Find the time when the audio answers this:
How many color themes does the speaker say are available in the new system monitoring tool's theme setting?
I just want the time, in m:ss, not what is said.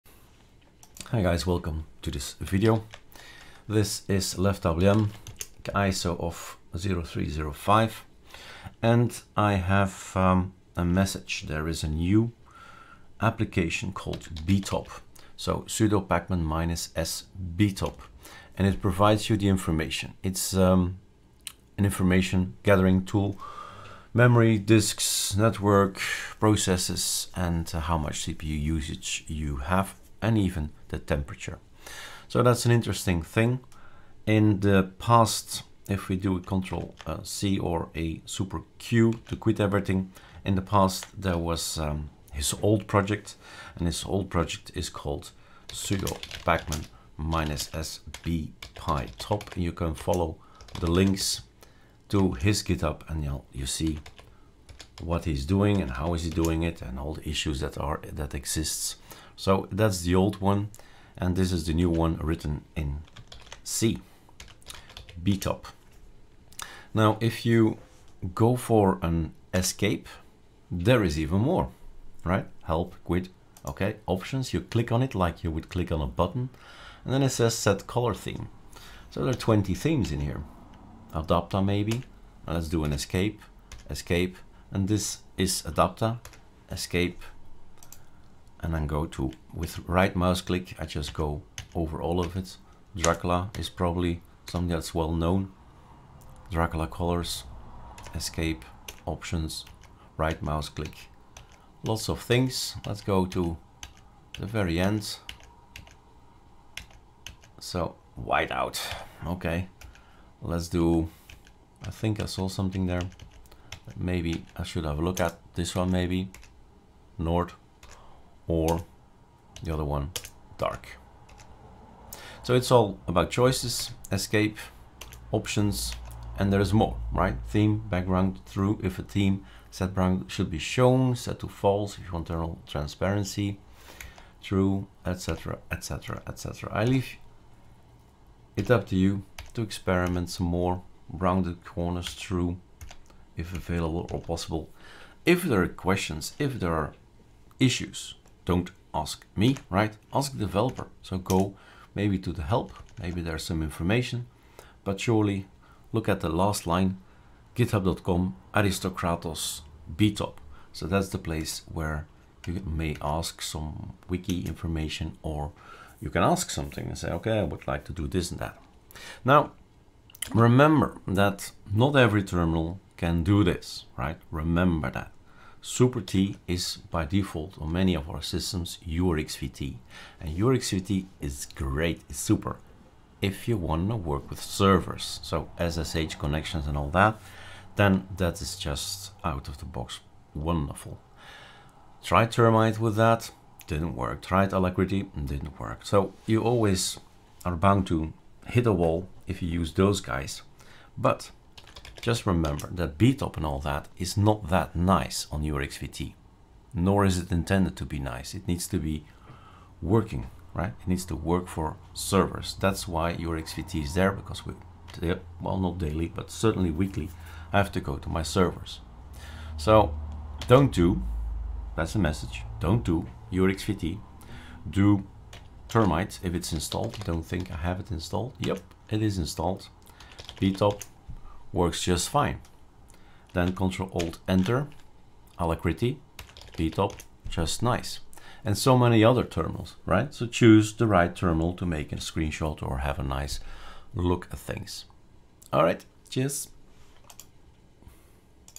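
1:19.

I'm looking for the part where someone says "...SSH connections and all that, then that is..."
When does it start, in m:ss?
3:05.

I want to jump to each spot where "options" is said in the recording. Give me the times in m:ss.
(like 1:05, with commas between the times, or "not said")
1:14, 1:39, 2:05.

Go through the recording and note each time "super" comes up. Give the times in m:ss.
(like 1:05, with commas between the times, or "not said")
0:38, 2:55, 3:02.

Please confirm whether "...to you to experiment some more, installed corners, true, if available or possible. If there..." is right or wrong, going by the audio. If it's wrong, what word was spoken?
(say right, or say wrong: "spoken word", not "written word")
wrong: "rounded", not "installed".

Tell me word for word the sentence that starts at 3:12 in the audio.
Tried Termite with that, didn't work.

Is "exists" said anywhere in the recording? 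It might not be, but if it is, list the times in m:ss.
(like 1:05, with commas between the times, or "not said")
0:58.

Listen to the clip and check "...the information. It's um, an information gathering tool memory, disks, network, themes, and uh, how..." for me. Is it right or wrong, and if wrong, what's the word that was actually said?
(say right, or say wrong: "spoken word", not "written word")
wrong: "processes", not "themes".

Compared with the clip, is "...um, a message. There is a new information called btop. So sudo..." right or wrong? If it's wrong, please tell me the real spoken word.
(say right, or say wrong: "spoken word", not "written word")
wrong: "application", not "information".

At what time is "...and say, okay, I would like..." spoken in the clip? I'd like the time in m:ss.
2:46.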